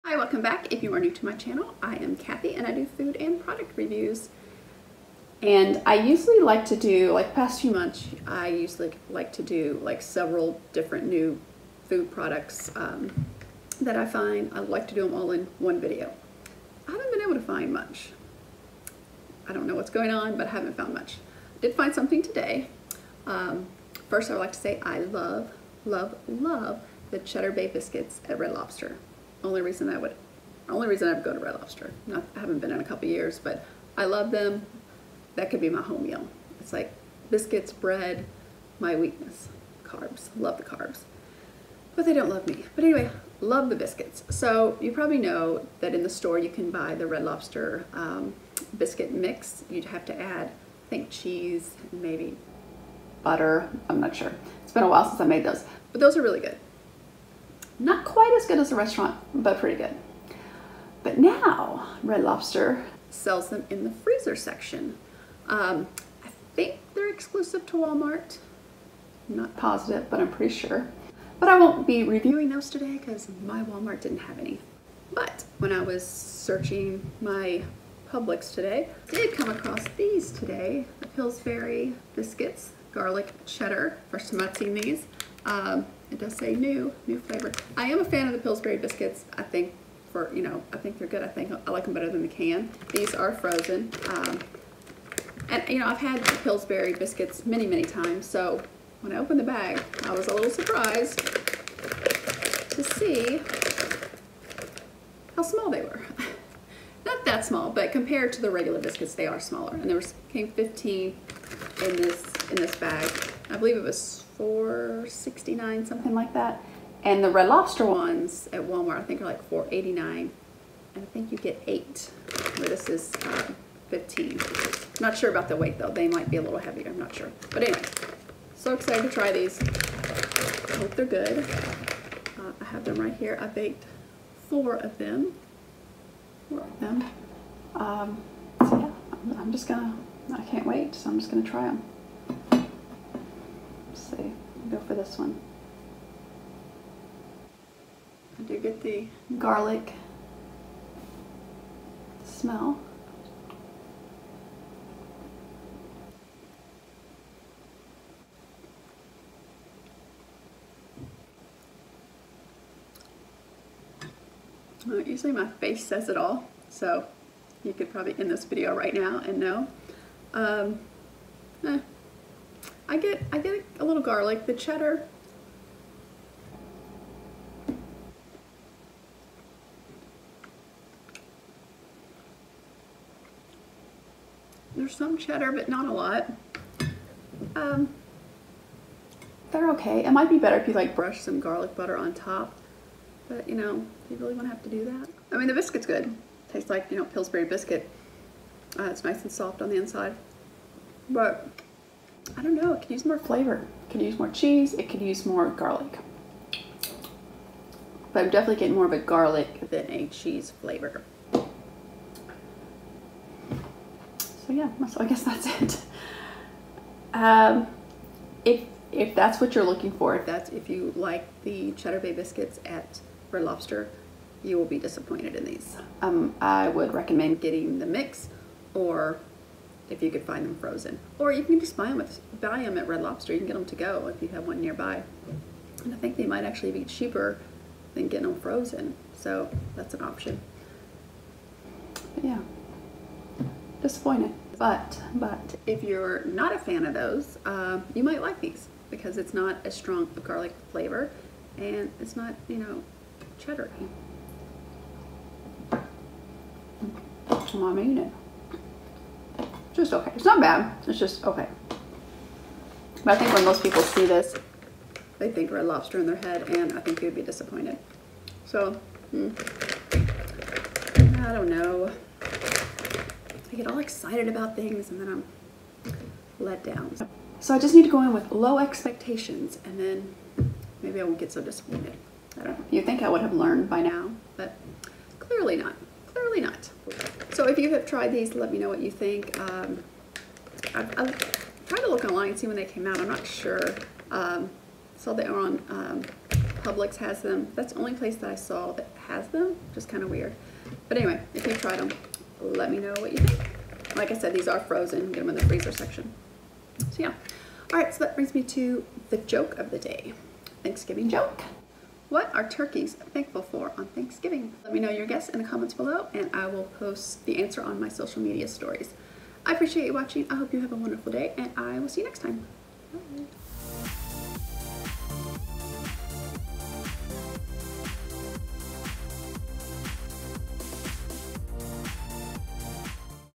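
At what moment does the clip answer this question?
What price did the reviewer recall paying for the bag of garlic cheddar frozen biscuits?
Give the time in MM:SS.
01:54.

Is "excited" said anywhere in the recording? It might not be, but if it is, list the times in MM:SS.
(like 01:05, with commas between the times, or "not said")
02:08, 04:33.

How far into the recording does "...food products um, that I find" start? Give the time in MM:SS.
00:11.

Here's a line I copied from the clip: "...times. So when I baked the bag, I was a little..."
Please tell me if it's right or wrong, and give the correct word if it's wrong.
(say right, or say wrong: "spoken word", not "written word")
wrong: "opened", not "baked".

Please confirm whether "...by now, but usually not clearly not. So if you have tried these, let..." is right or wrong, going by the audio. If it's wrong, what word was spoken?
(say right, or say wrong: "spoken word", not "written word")
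wrong: "clearly", not "usually".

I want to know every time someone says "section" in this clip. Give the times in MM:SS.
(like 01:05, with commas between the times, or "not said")
01:04, 05:05.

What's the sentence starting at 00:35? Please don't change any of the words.
That could be my home meal.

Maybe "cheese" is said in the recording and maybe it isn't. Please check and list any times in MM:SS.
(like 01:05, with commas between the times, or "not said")
00:51, 03:24, 03:30.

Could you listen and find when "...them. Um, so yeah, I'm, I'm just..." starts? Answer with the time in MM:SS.
02:16.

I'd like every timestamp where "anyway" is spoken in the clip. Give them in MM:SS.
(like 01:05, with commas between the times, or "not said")
00:42, 02:07, 05:00.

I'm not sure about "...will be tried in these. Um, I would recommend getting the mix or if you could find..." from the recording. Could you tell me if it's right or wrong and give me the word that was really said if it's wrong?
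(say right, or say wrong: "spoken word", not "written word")
wrong: "disappointed", not "tried".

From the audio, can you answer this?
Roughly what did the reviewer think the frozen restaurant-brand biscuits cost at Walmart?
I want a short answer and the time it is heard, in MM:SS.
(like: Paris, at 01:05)
$4.89, at 01:59.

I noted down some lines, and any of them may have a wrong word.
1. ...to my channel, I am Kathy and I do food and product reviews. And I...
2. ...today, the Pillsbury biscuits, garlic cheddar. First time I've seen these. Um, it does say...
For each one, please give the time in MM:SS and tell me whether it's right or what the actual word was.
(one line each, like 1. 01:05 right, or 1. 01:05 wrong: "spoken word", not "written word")
1. 00:01 right
2. 01:20 right.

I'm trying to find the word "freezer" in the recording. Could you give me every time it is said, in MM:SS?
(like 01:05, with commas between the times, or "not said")
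01:03, 05:05.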